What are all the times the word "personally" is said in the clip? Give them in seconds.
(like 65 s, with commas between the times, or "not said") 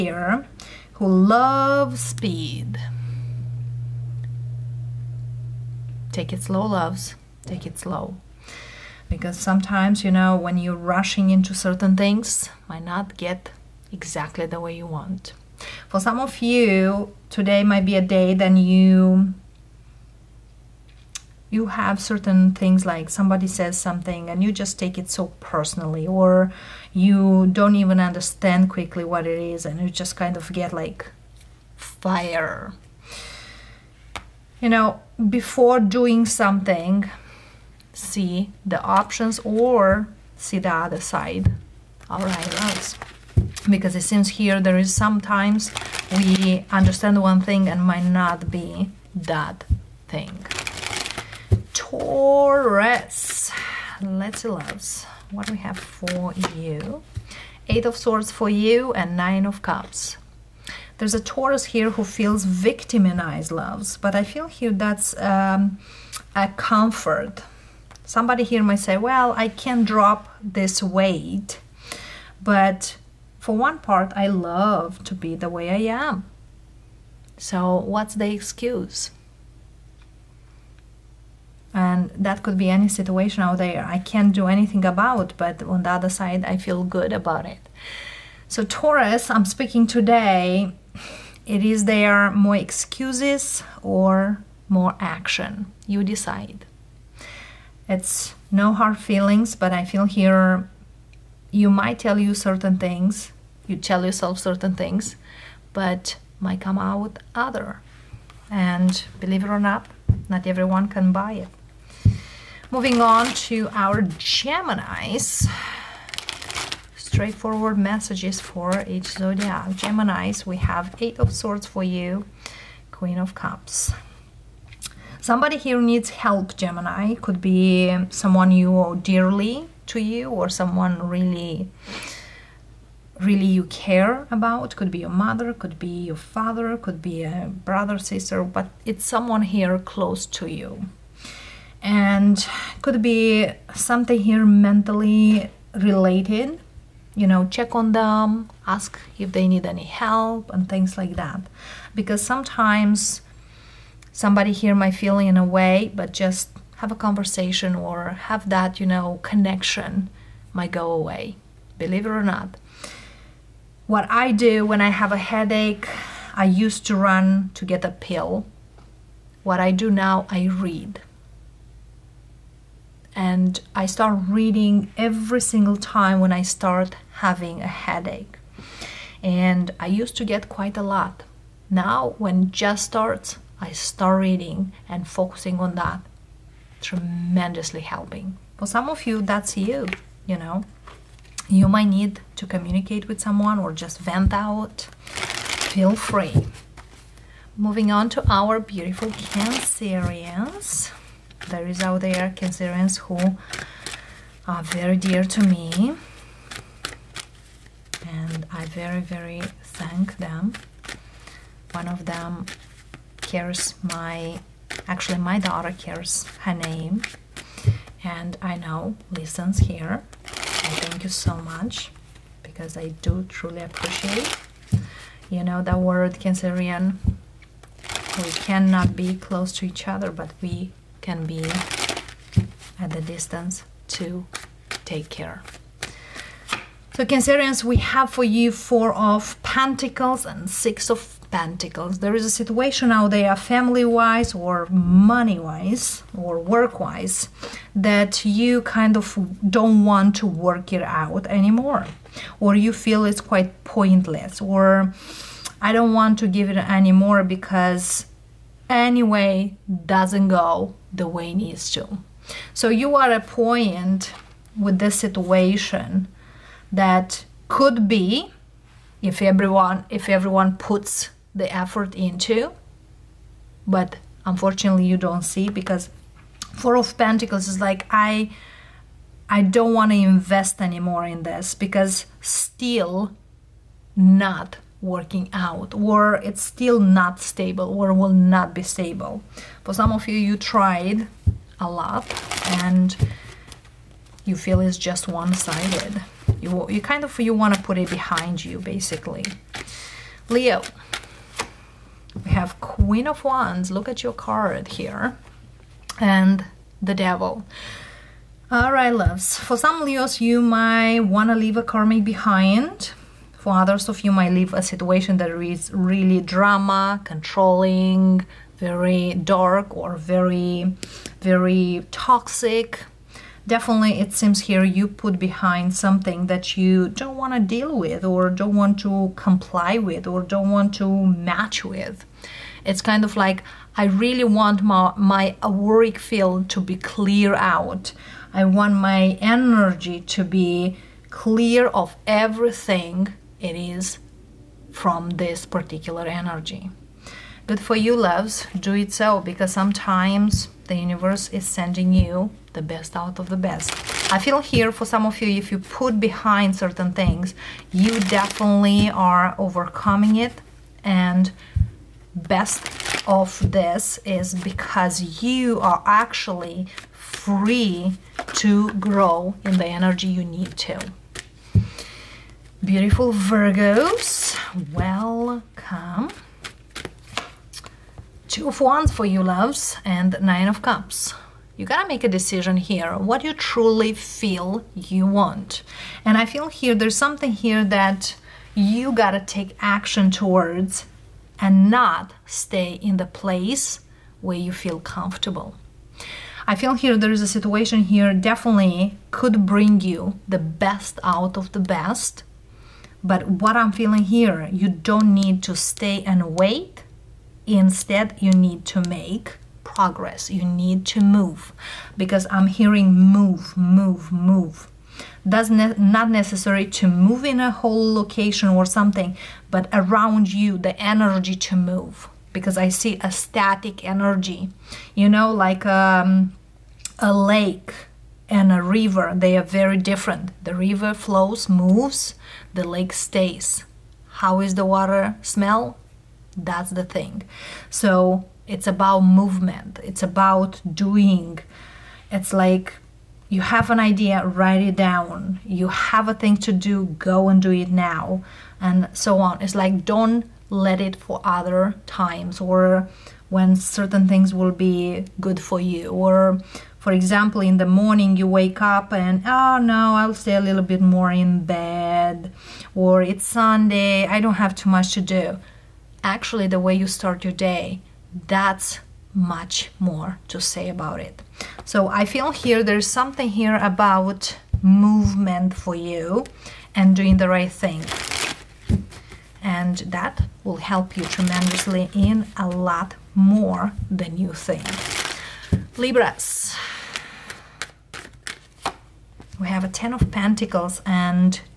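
25 s.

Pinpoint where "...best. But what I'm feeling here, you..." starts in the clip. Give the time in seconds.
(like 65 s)
401 s.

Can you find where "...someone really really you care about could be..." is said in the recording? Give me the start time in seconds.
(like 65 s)
130 s.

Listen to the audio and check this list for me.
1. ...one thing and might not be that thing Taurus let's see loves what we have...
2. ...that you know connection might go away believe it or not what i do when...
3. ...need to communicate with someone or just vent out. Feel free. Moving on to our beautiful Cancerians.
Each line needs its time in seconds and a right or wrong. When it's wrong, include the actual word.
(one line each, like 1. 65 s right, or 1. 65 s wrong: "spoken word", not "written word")
1. 47 s right
2. 158 s right
3. 191 s right.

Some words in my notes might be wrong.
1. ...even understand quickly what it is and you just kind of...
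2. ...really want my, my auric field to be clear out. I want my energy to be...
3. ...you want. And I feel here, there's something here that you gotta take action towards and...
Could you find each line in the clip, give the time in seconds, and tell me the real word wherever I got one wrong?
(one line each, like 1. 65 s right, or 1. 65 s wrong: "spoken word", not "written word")
1. 27 s right
2. 333 s right
3. 384 s right.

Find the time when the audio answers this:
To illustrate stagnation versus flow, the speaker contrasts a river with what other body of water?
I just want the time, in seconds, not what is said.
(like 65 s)
426 s.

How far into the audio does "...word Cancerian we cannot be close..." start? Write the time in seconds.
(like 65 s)
225 s.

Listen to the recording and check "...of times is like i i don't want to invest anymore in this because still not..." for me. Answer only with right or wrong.
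wrong.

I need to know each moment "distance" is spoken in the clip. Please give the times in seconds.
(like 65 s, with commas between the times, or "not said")
233 s.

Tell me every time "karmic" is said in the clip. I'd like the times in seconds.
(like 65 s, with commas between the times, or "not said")
311 s.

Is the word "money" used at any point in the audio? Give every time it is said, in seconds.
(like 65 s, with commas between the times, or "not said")
244 s.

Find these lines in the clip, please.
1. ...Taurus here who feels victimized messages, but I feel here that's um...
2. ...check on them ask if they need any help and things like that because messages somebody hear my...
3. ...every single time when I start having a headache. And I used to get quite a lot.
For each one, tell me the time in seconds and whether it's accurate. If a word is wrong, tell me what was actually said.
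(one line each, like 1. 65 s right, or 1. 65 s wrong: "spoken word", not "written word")
1. 61 s wrong: "loves", not "messages"
2. 147 s wrong: "sometimes", not "messages"
3. 174 s right.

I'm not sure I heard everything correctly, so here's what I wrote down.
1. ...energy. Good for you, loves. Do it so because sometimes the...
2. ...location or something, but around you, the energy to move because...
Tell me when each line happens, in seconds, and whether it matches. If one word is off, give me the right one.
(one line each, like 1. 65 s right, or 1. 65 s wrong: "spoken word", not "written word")
1. 346 s right
2. 417 s right.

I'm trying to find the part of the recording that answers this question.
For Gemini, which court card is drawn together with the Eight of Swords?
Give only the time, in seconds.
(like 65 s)
122 s.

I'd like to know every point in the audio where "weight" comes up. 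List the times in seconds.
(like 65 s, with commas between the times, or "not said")
70 s.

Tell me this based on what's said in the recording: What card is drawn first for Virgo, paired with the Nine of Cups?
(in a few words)
Two of Wands.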